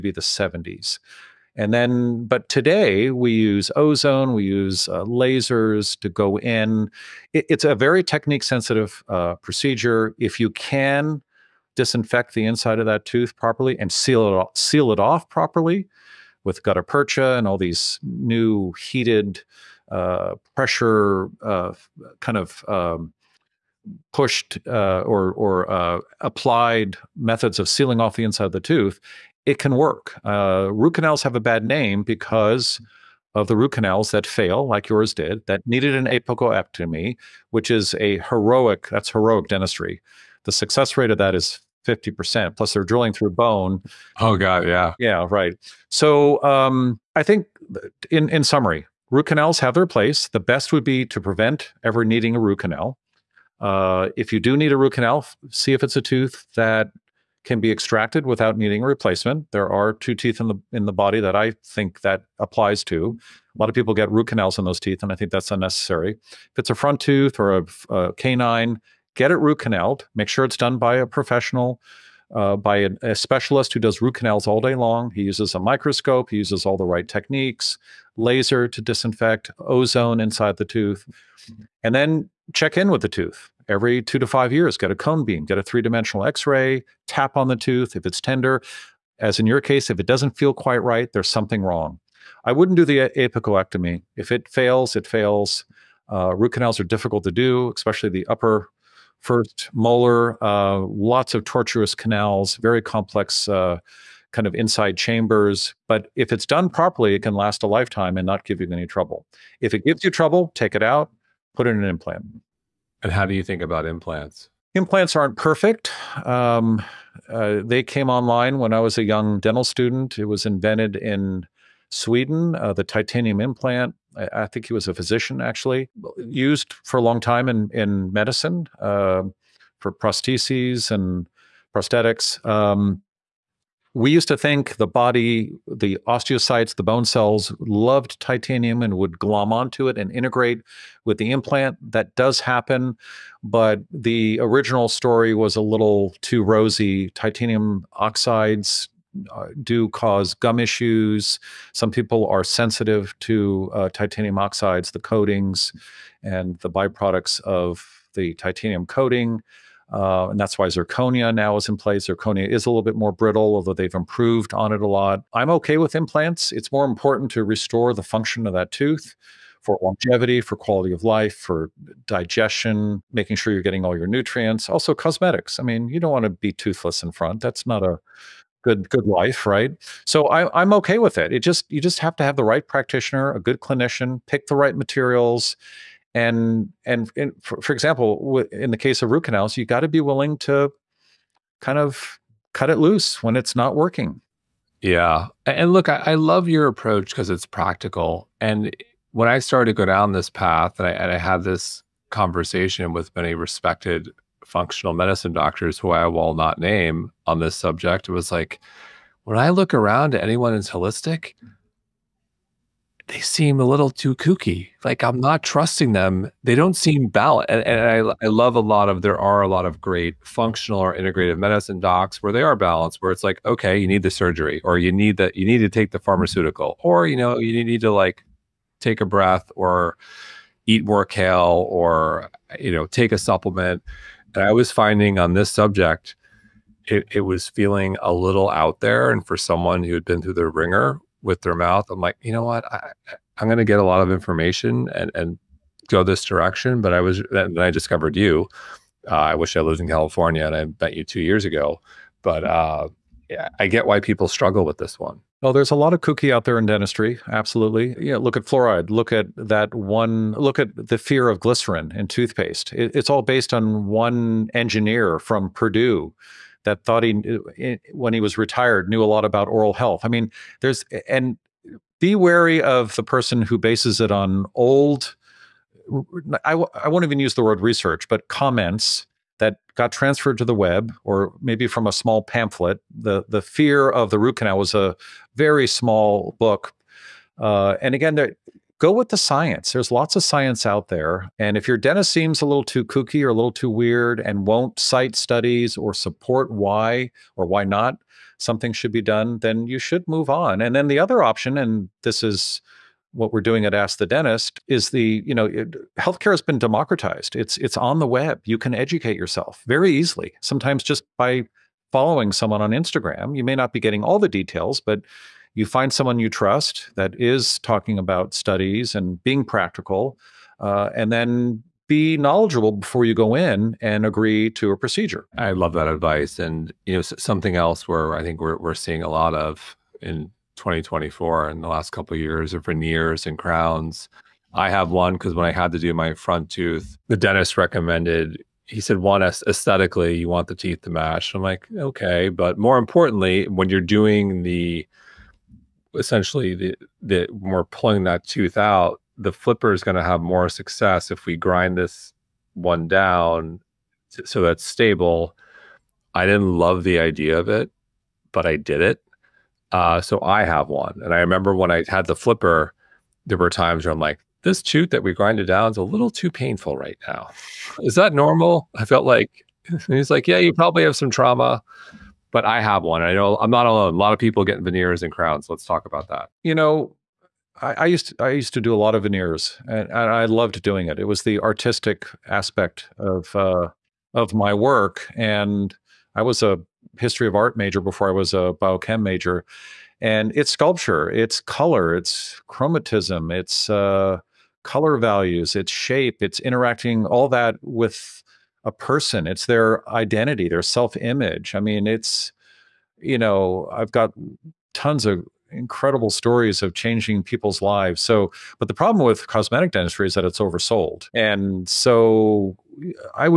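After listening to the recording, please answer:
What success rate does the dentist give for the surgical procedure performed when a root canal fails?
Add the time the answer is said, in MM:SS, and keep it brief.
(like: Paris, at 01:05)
50%, at 00:41.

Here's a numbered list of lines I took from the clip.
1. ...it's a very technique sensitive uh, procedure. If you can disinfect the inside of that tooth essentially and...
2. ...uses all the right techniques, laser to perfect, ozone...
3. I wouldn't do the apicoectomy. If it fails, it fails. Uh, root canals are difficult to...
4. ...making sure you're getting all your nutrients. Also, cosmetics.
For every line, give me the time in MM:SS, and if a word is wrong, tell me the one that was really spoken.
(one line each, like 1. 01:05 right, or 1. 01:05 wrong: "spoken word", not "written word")
1. 00:07 wrong: "properly", not "essentially"
2. 01:16 wrong: "disinfect", not "perfect"
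3. 01:32 right
4. 02:53 right.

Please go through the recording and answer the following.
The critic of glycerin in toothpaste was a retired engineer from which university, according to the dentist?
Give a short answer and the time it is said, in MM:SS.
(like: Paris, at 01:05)
Purdue, at 04:25.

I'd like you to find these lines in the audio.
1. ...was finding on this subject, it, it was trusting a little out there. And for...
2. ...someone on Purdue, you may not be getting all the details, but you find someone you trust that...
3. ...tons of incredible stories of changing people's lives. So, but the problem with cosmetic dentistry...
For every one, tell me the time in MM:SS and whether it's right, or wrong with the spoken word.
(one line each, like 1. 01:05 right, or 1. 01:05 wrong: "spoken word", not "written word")
1. 03:54 wrong: "feeling", not "trusting"
2. 05:12 wrong: "Instagram", not "Purdue"
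3. 06:44 right.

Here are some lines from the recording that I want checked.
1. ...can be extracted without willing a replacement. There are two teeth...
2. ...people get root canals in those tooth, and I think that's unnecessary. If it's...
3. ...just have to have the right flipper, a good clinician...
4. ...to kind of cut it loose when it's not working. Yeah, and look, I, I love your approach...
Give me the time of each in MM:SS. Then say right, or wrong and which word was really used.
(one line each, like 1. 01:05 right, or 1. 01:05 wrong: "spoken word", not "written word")
1. 00:57 wrong: "needing", not "willing"
2. 01:03 wrong: "teeth", not "tooth"
3. 03:01 wrong: "practitioner", not "flipper"
4. 03:10 right.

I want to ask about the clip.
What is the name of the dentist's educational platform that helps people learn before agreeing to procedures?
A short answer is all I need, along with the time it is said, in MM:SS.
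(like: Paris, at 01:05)
Ask the Dentist, at 05:03.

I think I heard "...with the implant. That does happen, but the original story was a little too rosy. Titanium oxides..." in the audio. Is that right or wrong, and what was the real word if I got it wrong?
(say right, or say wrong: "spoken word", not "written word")
right.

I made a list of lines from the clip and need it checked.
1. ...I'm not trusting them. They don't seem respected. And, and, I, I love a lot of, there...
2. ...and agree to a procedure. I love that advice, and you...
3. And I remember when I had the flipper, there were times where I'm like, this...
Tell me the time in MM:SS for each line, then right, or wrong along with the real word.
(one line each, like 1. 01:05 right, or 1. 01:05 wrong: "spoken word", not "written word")
1. 03:35 wrong: "balanced", not "respected"
2. 05:23 right
3. 06:01 right.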